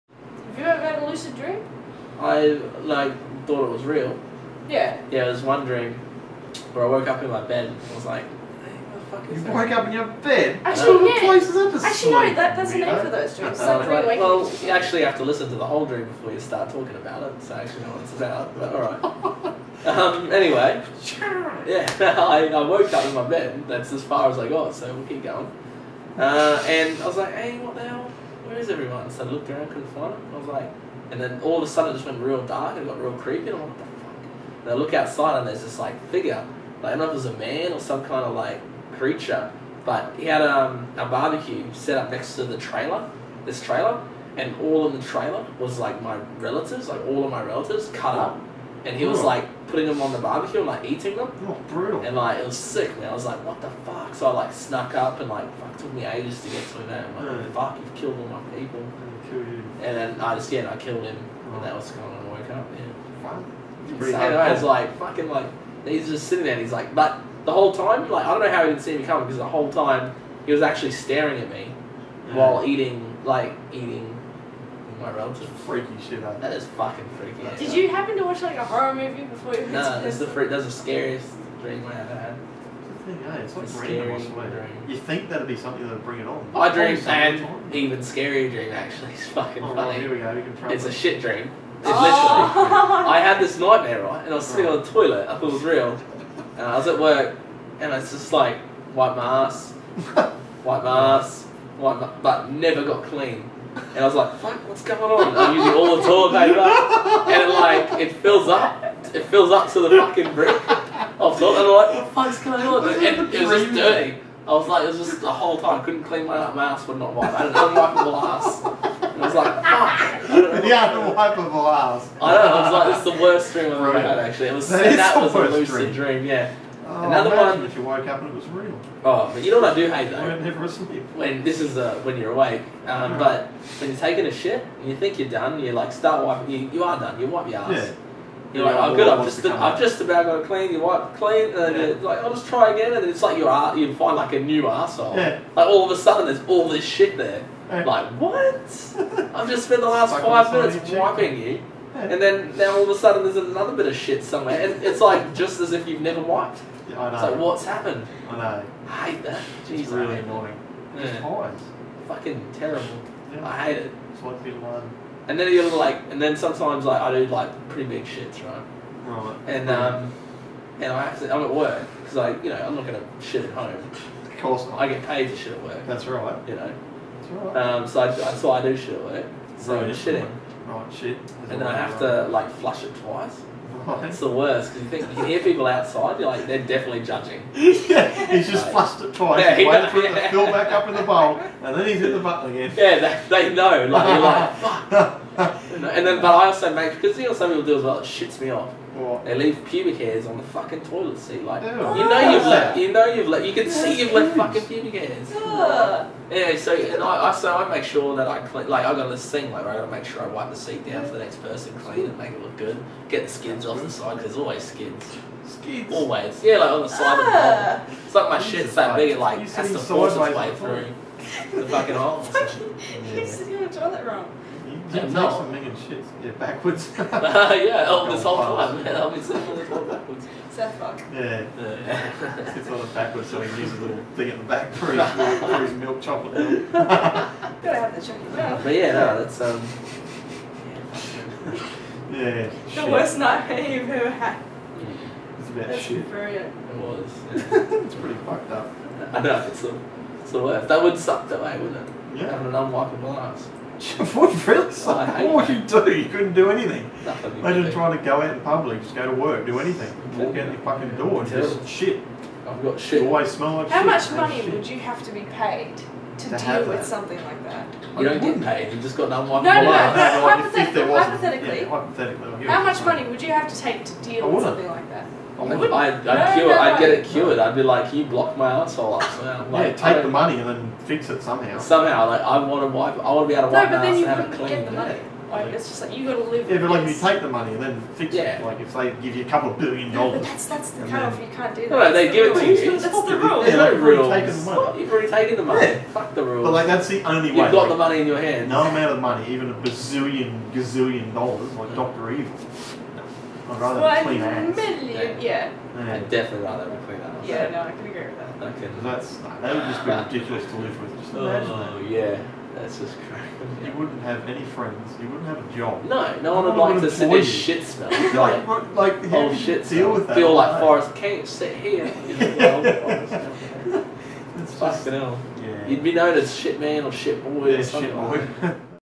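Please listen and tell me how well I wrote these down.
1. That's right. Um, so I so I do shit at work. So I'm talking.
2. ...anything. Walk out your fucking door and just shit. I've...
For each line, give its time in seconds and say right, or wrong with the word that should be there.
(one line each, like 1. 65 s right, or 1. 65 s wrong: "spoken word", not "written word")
1. 177 s wrong: "shitting", not "talking"
2. 259 s right.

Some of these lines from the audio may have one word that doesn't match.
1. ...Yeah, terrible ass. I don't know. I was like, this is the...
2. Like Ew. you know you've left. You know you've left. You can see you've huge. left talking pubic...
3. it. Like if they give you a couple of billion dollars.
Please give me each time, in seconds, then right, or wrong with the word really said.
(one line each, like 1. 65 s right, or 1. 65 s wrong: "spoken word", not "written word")
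1. 120 s wrong: "unwipeable", not "terrible"
2. 201 s wrong: "fucking", not "talking"
3. 288 s right.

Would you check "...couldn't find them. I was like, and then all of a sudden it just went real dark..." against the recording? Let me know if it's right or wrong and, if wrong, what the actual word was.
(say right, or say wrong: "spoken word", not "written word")
right.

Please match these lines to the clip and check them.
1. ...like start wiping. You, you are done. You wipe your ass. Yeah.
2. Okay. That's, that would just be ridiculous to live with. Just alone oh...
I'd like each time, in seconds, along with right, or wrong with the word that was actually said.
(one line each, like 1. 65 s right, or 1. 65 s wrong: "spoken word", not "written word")
1. 135 s right
2. 308 s wrong: "imagine", not "alone".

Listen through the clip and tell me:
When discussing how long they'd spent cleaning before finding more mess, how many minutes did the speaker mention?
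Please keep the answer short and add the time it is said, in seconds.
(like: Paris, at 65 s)
5, at 150 s.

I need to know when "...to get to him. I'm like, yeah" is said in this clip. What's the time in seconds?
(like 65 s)
56 s.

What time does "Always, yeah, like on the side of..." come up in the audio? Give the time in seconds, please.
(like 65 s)
215 s.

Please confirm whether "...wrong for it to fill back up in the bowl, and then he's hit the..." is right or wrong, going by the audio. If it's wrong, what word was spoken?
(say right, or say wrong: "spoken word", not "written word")
wrong: "waiting", not "wrong".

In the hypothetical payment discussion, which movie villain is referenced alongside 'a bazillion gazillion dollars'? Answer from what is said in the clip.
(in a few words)
Doctor Evil.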